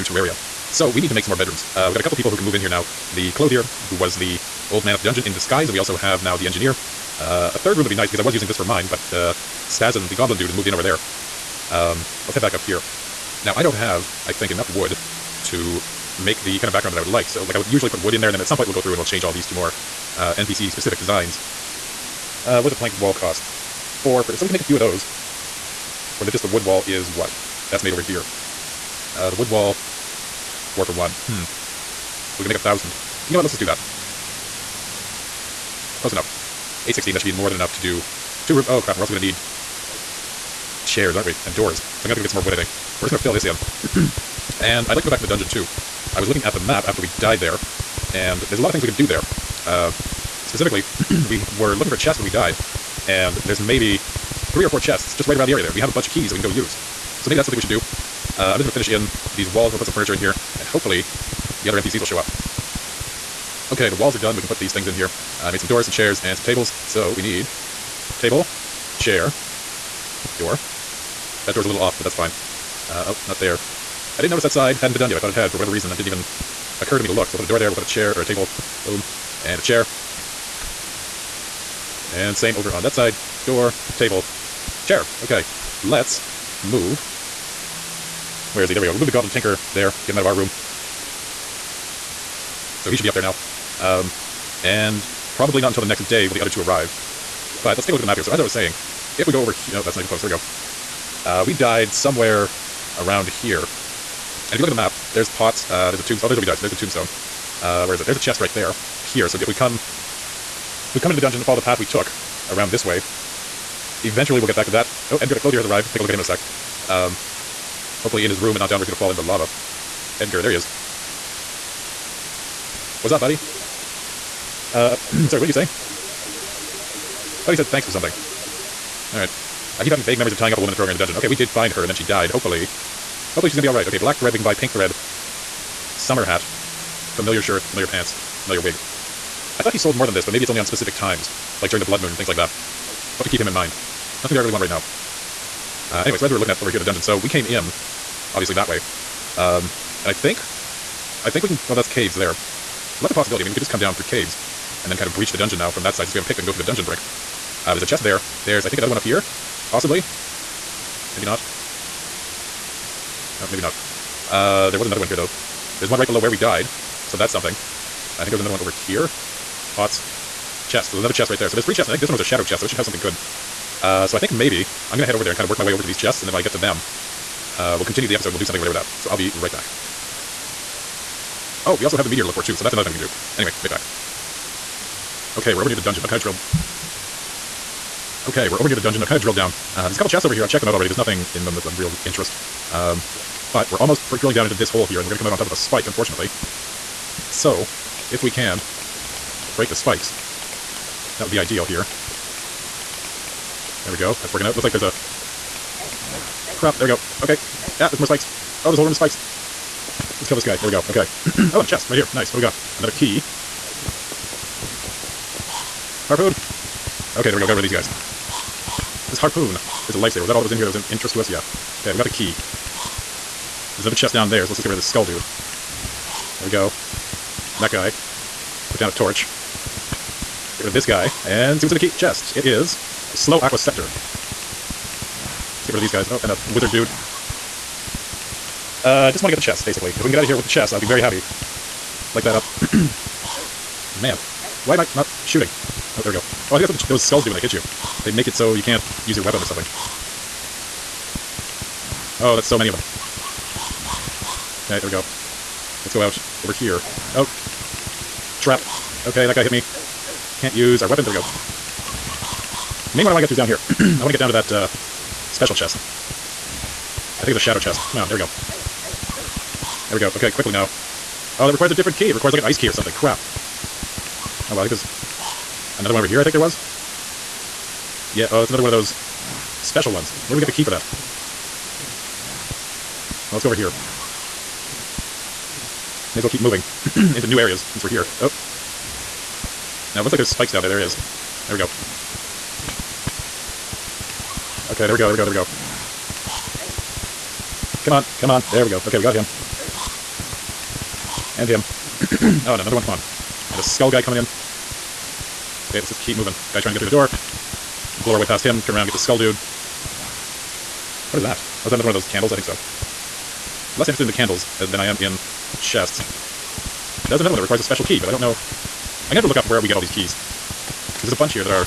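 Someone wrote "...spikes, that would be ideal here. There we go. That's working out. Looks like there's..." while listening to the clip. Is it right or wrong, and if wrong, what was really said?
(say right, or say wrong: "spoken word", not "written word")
right.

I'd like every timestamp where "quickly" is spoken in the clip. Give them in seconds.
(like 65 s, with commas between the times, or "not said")
270 s.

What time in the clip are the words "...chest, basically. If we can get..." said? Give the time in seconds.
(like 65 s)
239 s.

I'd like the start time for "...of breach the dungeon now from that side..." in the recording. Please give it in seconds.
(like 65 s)
155 s.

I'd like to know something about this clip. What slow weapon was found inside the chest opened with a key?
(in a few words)
Aqua scepter.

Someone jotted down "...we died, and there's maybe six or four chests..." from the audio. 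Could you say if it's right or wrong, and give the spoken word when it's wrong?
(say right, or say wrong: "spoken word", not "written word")
wrong: "three", not "six".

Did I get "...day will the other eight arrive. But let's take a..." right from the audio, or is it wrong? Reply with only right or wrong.
wrong.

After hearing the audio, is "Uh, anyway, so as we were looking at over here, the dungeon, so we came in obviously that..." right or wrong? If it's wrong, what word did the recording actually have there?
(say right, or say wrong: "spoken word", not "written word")
right.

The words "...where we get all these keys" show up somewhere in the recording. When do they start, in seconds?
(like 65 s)
319 s.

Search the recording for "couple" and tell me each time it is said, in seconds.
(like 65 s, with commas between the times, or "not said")
2 s, 189 s.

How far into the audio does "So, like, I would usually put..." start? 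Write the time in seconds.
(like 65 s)
17 s.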